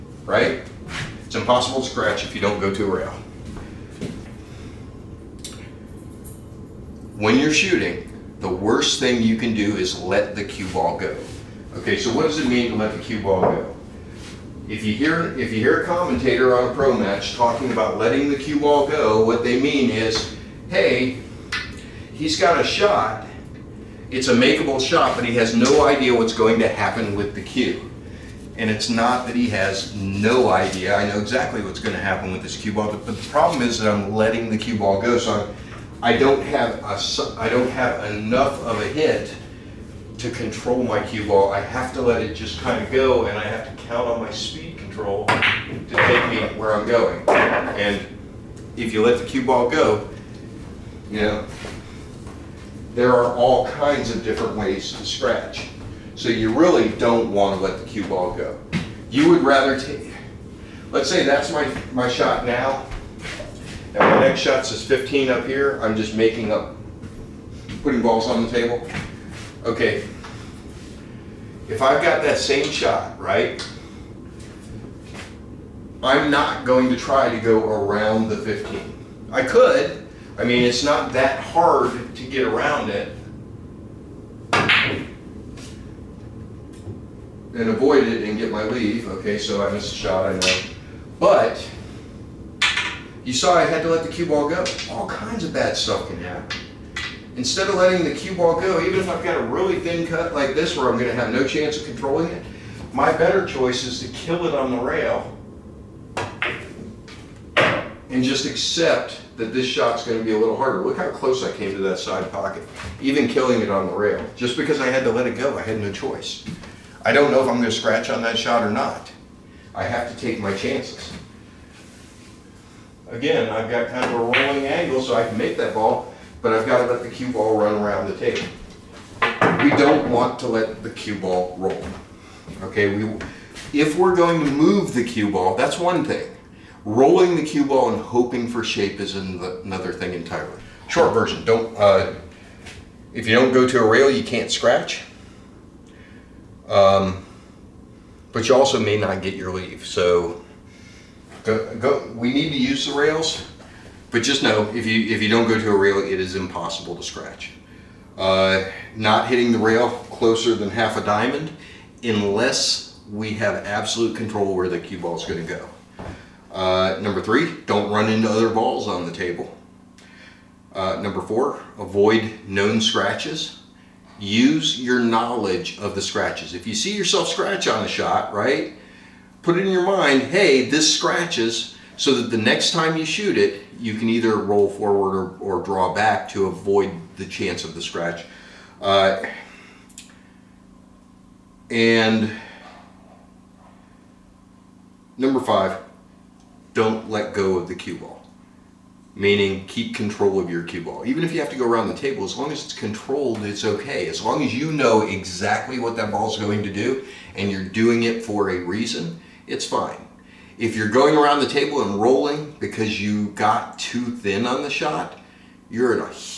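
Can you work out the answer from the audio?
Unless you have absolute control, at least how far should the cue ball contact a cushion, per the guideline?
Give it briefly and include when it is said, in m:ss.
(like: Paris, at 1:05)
half a diamond, at 2:40.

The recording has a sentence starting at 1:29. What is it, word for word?
Okay, so I missed a shot, I know.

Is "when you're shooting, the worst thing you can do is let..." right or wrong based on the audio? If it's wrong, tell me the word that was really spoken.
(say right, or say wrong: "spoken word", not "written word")
right.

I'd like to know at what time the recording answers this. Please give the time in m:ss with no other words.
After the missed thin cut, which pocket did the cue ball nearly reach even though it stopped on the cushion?
1:51.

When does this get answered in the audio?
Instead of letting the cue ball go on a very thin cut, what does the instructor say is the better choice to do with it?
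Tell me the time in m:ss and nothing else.
1:44.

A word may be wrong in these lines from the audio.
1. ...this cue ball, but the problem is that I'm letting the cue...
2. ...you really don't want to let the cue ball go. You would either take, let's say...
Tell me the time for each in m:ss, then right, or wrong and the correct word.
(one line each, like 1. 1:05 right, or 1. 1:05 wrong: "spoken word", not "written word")
1. 0:32 right
2. 0:56 wrong: "rather", not "either".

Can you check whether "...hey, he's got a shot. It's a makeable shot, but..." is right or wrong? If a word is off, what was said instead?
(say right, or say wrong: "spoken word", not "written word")
right.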